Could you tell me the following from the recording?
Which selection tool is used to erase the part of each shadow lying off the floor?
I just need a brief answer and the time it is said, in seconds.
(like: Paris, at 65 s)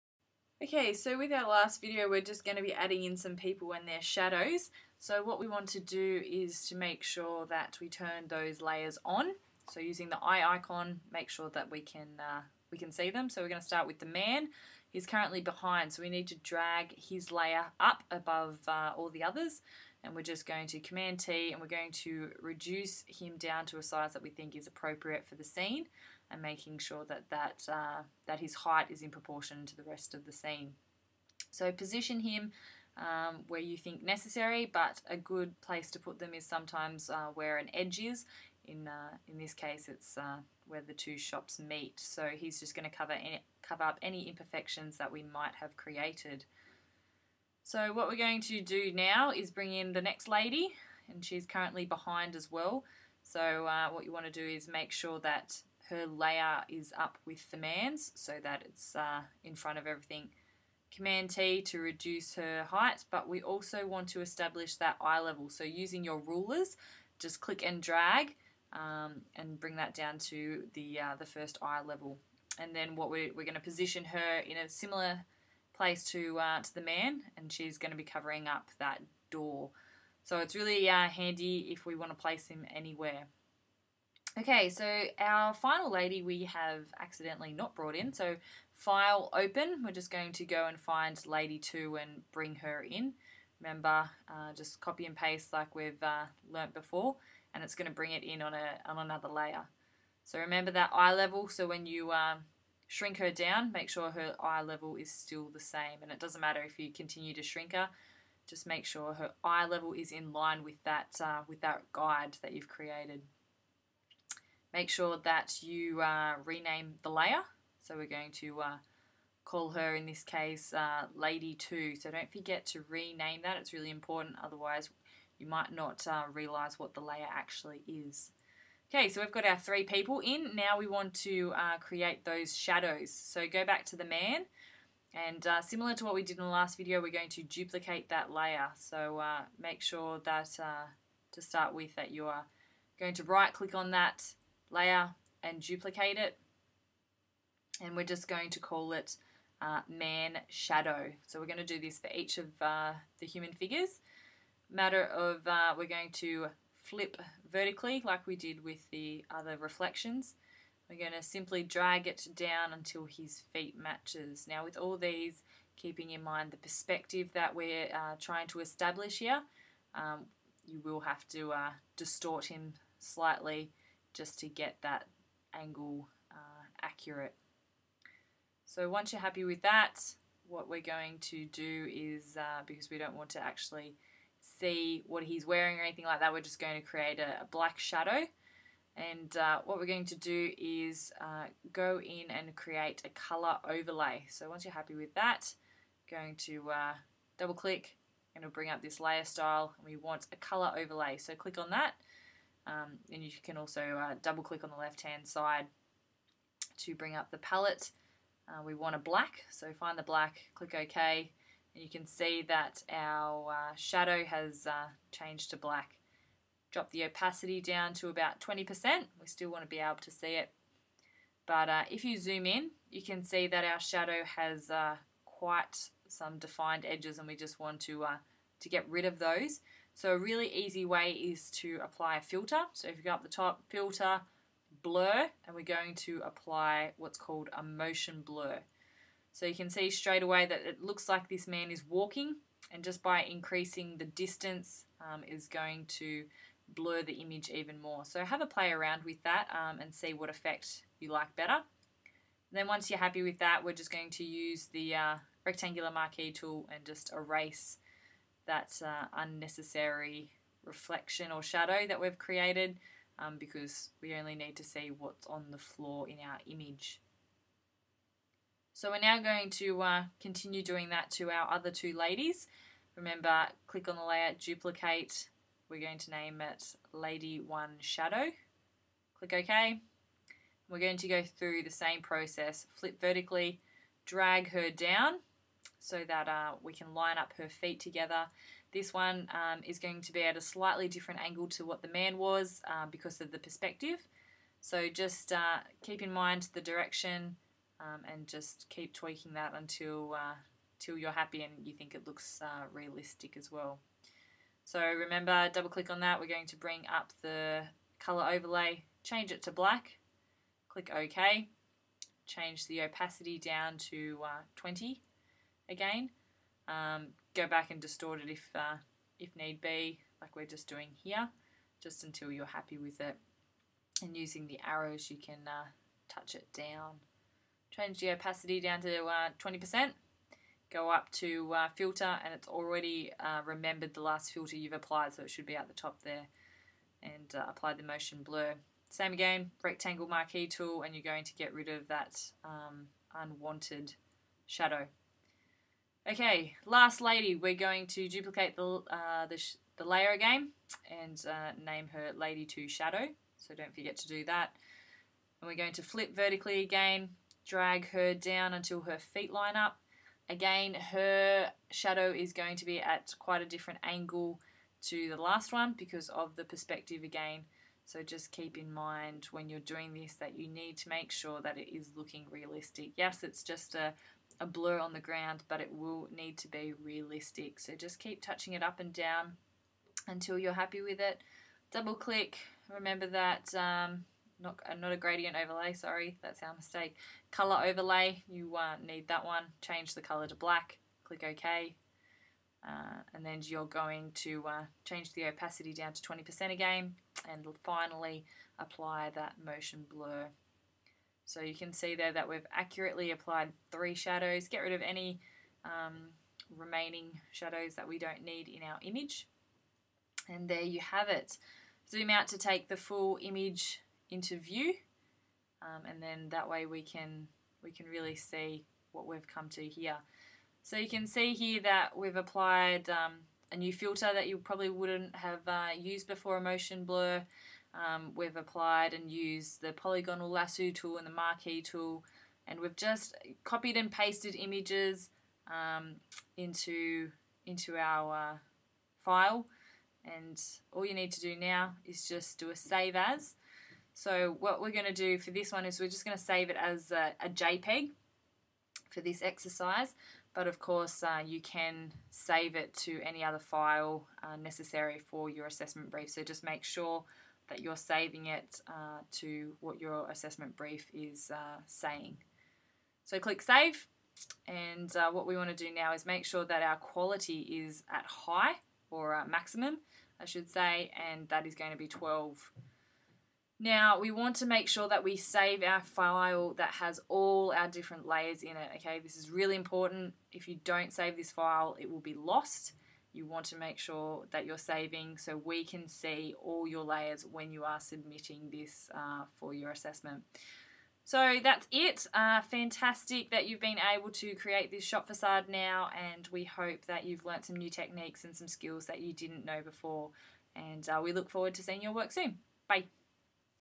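Rectangular marquee tool, at 255 s.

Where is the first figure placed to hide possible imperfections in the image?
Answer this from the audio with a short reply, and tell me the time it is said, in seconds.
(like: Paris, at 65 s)
Where the two shops meet, at 40 s.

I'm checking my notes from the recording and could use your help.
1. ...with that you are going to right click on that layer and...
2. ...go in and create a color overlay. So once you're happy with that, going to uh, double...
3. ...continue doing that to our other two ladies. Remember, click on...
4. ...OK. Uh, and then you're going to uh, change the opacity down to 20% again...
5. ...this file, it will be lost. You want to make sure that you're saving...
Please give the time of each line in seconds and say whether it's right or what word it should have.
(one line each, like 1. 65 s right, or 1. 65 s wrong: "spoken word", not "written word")
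1. 141 s right
2. 191 s right
3. 270 s right
4. 391 s right
5. 481 s right.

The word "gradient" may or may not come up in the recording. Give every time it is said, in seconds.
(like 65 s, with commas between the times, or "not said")
384 s.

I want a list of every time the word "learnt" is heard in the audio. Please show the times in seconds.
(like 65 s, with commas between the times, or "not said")
96 s, 497 s.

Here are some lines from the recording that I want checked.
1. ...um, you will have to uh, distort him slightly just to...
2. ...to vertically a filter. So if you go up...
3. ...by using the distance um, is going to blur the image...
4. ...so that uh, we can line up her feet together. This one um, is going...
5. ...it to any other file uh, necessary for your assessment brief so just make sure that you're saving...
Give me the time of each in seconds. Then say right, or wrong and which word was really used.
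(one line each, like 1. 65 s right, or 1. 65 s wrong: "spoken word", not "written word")
1. 169 s right
2. 231 s wrong: "apply", not "vertically"
3. 243 s wrong: "increasing", not "using"
4. 285 s right
5. 452 s right.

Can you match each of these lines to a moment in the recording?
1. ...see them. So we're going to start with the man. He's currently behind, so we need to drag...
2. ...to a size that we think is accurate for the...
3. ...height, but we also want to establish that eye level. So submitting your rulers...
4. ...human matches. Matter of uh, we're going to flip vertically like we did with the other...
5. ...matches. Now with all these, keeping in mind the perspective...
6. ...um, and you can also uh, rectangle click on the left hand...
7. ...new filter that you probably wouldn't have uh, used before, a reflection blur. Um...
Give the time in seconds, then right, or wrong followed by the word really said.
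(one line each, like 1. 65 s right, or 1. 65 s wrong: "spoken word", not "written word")
1. 12 s right
2. 23 s wrong: "appropriate", not "accurate"
3. 62 s wrong: "using", not "submitting"
4. 153 s wrong: "figures", not "matches"
5. 163 s right
6. 202 s wrong: "double", not "rectangle"
7. 423 s wrong: "motion", not "reflection".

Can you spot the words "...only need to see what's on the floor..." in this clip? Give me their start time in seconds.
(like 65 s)
264 s.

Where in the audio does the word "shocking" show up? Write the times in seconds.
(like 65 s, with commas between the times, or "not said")
not said.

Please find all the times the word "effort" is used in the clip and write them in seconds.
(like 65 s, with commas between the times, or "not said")
not said.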